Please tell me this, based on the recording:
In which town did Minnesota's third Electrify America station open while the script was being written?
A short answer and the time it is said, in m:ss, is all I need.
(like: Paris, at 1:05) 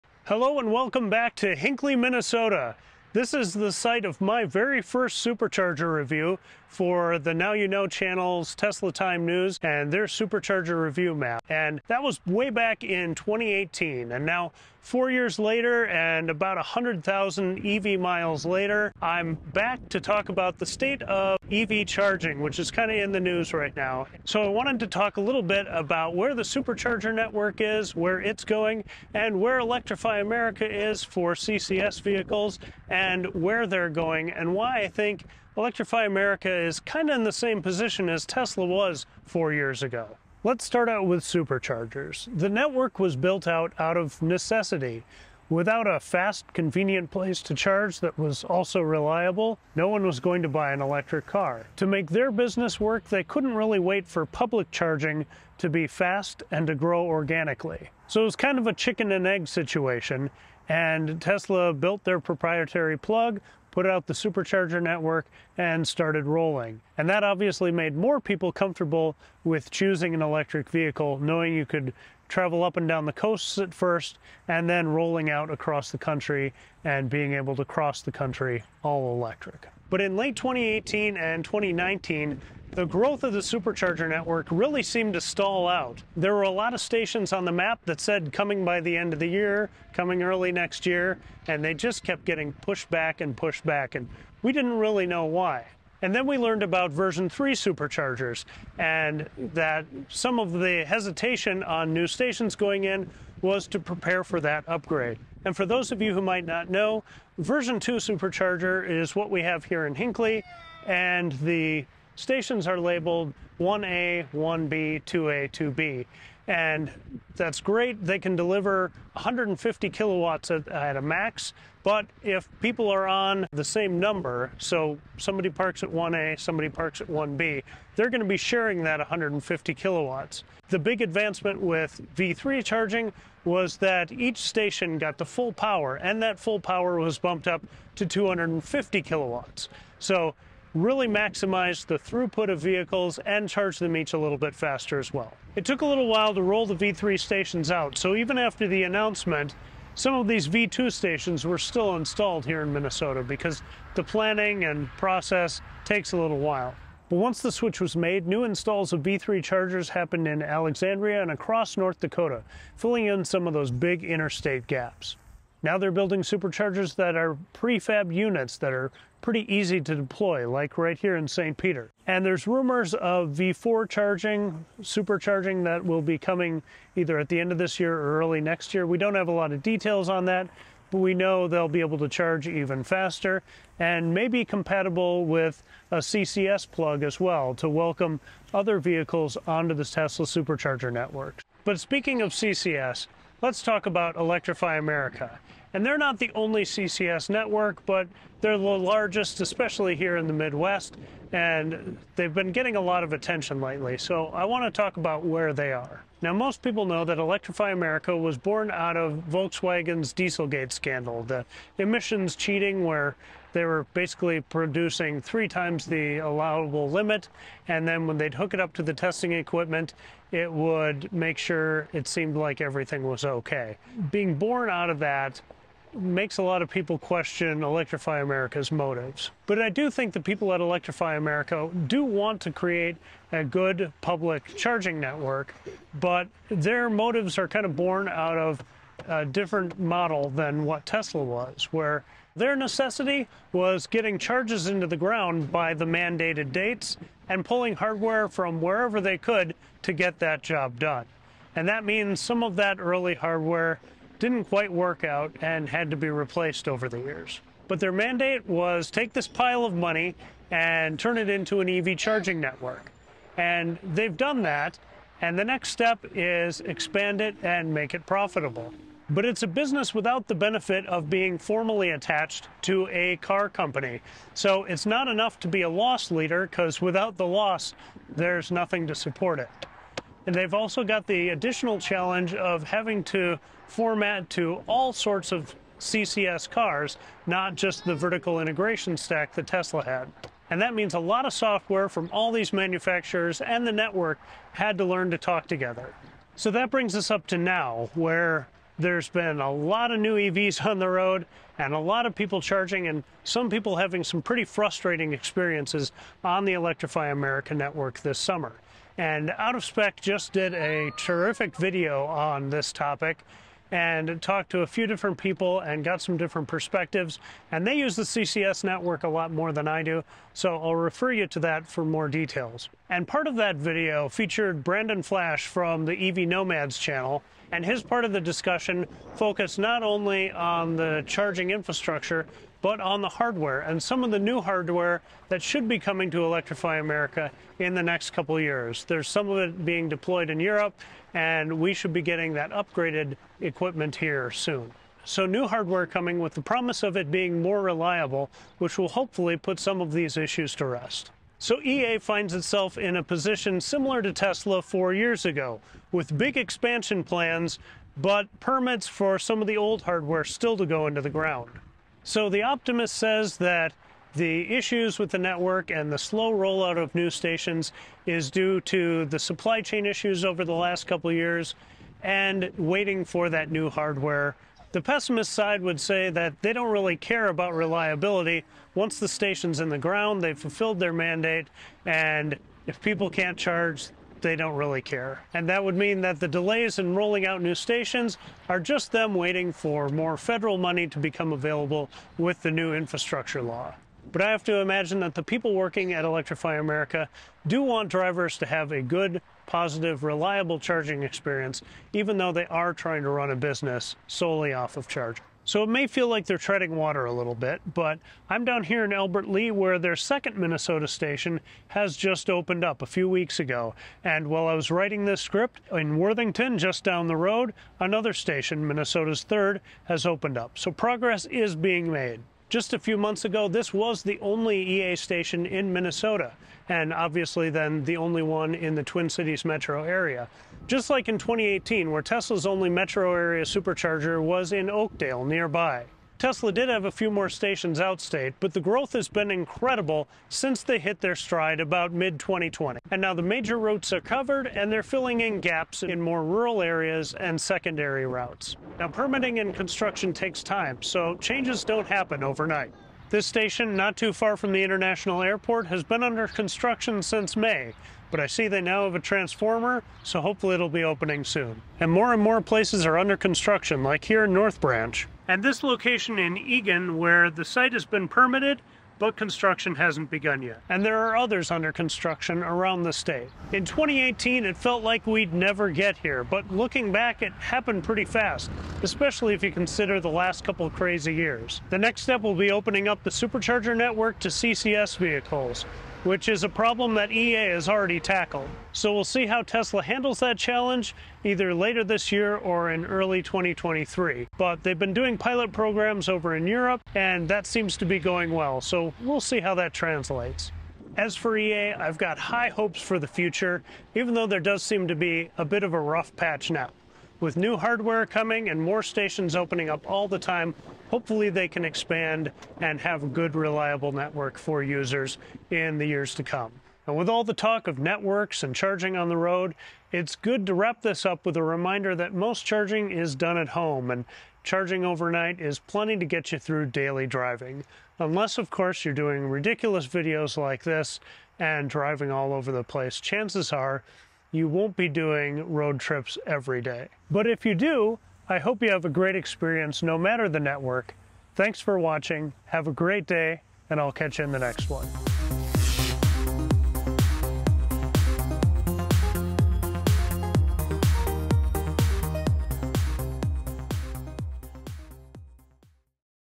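Worthington, at 6:55.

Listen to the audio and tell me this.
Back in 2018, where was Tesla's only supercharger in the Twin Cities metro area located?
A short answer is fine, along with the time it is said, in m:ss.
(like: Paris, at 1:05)
Oakdale, at 7:14.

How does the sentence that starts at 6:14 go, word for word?
The pessimist side would say that they don't really care about reliability.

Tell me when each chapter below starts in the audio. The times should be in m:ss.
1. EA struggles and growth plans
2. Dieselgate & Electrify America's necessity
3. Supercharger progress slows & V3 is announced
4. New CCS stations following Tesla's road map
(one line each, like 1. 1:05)
1. 4:56
2. 3:11
3. 1:20
4. 6:45.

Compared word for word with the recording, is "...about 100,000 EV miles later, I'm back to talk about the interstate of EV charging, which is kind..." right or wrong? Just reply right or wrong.
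wrong.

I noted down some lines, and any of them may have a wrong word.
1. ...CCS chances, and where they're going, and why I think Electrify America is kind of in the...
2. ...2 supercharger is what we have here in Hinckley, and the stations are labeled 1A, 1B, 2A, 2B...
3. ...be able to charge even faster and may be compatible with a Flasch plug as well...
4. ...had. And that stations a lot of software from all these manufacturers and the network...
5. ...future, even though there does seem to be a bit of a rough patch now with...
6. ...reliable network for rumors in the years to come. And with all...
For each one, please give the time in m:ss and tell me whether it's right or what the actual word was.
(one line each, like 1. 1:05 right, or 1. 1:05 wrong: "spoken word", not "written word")
1. 0:31 wrong: "vehicles", not "chances"
2. 1:47 right
3. 3:01 wrong: "CCS", not "Flasch"
4. 4:49 wrong: "means", not "stations"
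5. 8:23 right
6. 8:33 wrong: "users", not "rumors".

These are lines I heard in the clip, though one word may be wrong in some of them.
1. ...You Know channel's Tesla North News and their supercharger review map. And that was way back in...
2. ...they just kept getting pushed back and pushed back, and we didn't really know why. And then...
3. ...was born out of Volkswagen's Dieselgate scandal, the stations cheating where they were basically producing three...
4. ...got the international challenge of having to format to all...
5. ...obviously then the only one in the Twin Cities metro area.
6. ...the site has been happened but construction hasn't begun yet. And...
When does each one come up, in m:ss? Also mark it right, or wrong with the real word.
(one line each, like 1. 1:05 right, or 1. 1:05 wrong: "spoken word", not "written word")
1. 0:07 wrong: "Time", not "North"
2. 1:31 right
3. 3:28 wrong: "emissions", not "stations"
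4. 4:40 wrong: "additional", not "international"
5. 7:06 right
6. 7:47 wrong: "permitted", not "happened".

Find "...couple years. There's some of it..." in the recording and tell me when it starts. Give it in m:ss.
5:38.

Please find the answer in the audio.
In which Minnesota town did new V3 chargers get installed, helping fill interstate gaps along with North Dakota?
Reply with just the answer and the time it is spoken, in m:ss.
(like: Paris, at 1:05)
Alexandria, at 2:40.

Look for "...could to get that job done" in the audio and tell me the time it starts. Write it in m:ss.
4:09.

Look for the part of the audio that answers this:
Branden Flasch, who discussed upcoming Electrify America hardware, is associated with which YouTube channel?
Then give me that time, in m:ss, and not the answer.
5:26.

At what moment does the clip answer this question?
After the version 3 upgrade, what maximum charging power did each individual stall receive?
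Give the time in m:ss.
2:18.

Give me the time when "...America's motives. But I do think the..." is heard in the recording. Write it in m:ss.
3:48.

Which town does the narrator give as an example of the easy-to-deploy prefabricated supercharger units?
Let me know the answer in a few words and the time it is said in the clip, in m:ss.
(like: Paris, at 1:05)
St. Peter, at 2:51.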